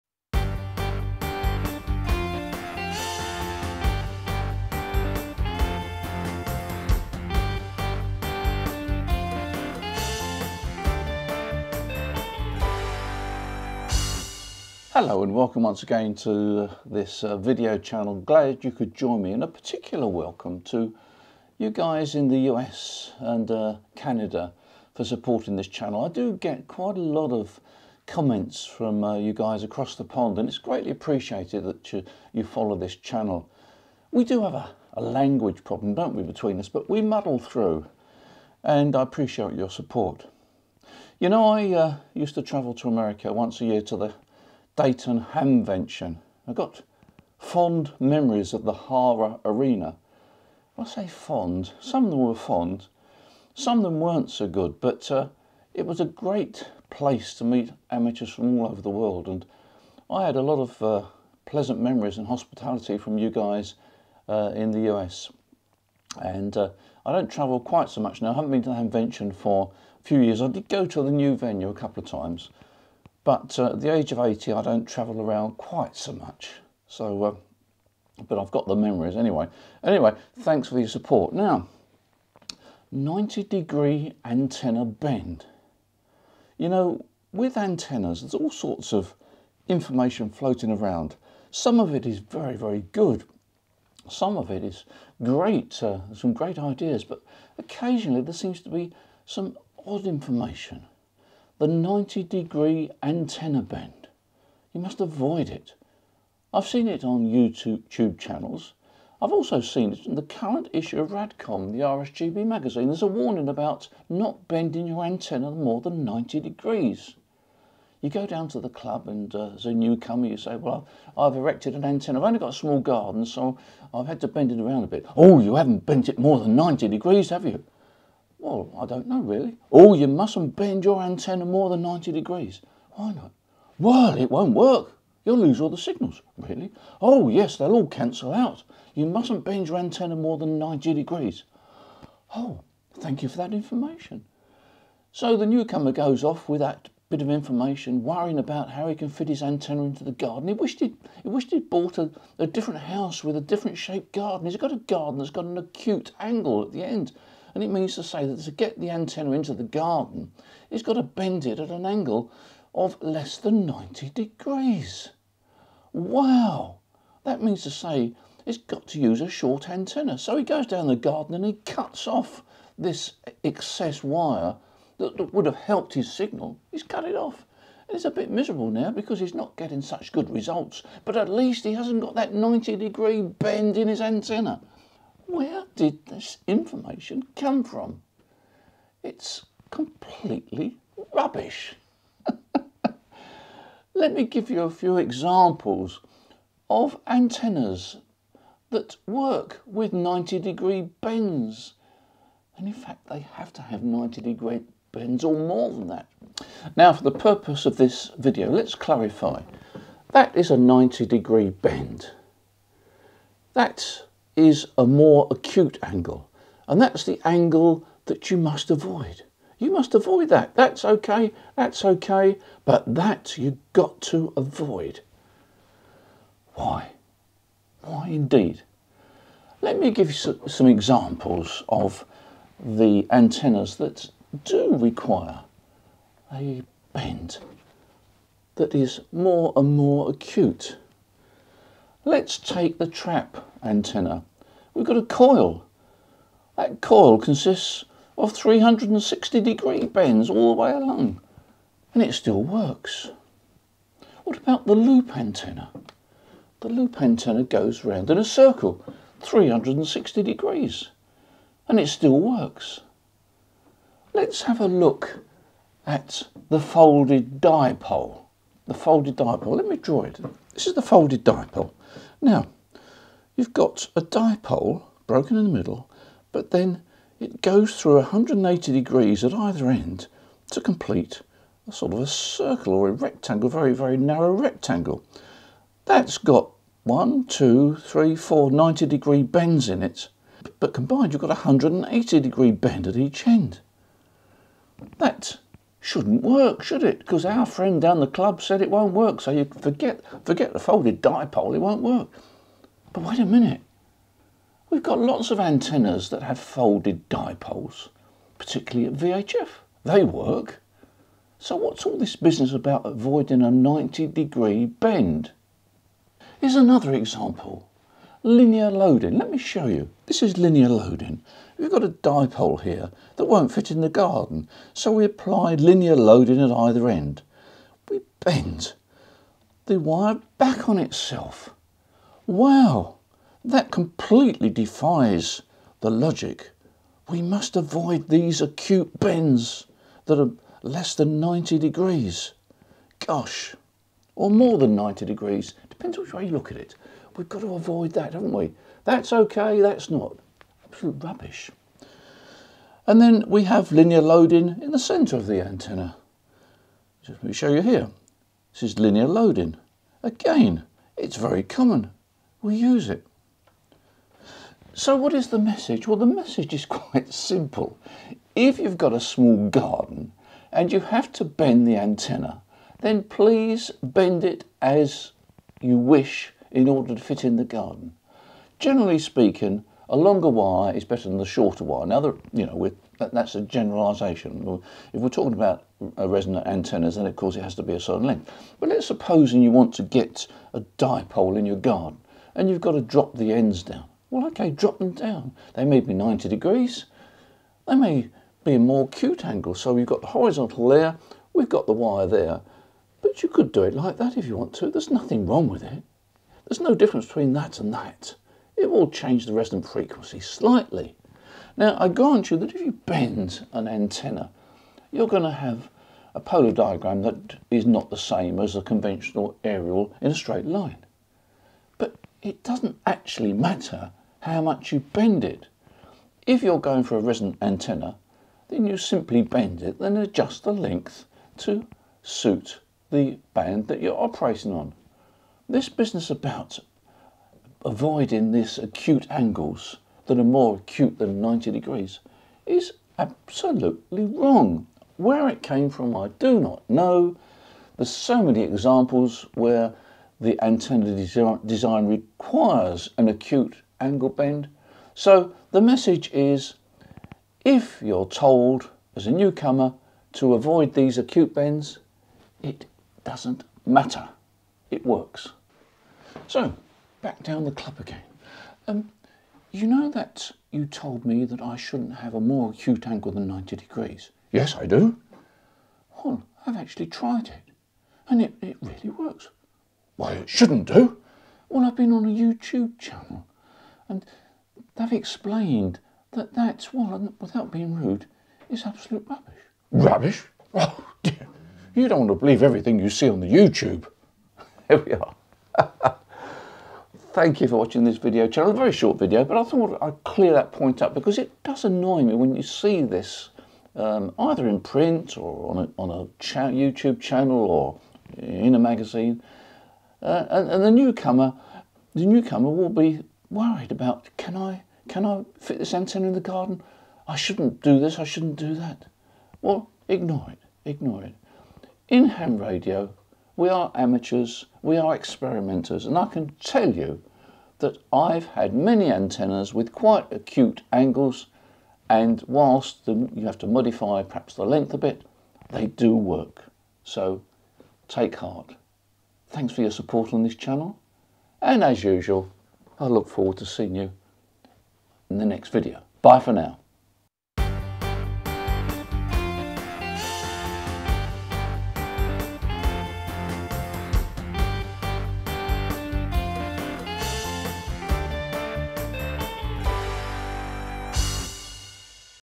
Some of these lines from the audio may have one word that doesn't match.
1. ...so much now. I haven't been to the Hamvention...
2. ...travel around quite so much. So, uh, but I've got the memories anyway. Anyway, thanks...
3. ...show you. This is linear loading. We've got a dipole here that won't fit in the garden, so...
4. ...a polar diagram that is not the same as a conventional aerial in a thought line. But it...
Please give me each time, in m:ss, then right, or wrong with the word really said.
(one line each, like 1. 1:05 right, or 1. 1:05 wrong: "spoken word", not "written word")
1. 1:07 right
2. 1:14 right
3. 5:19 right
4. 6:56 wrong: "straight", not "thought".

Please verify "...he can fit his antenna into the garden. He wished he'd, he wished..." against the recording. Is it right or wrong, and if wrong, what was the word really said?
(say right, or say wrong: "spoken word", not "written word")
right.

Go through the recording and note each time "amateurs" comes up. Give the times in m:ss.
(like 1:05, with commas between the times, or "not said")
0:57, 8:43.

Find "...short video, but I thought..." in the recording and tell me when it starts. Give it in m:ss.
8:18.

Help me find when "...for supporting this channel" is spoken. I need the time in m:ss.
0:24.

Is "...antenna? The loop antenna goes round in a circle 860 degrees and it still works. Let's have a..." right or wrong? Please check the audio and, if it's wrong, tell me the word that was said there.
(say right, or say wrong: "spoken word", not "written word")
wrong: "360", not "860".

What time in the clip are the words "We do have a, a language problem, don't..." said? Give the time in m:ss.
0:34.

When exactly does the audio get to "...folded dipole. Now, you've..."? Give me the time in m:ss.
4:30.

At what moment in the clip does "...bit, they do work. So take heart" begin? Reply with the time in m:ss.
8:54.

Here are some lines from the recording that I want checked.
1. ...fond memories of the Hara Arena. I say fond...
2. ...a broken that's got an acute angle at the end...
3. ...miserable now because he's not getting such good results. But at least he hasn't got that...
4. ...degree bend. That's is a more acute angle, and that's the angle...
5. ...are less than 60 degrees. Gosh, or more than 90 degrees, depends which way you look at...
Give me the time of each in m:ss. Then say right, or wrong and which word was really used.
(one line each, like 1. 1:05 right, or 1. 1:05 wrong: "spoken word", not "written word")
1. 0:47 right
2. 2:34 wrong: "garden", not "broken"
3. 2:58 right
4. 3:31 right
5. 5:40 wrong: "90", not "60".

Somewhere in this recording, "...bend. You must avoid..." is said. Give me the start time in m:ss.
1:43.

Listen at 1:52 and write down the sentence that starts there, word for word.
There's a warning about not bending your antenna more than 90 degrees.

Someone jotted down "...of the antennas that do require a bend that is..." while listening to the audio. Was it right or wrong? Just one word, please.
right.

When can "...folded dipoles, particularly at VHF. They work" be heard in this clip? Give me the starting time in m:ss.
5:06.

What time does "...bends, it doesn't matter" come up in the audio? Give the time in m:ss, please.
7:41.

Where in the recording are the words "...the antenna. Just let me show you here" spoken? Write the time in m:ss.
5:55.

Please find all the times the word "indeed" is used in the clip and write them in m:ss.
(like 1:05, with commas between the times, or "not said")
3:48.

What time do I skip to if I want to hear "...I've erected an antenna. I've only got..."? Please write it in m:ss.
2:01.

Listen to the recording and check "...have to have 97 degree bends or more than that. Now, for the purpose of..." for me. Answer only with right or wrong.
wrong.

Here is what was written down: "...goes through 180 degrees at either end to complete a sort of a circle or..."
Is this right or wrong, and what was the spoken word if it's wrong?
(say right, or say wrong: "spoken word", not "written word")
right.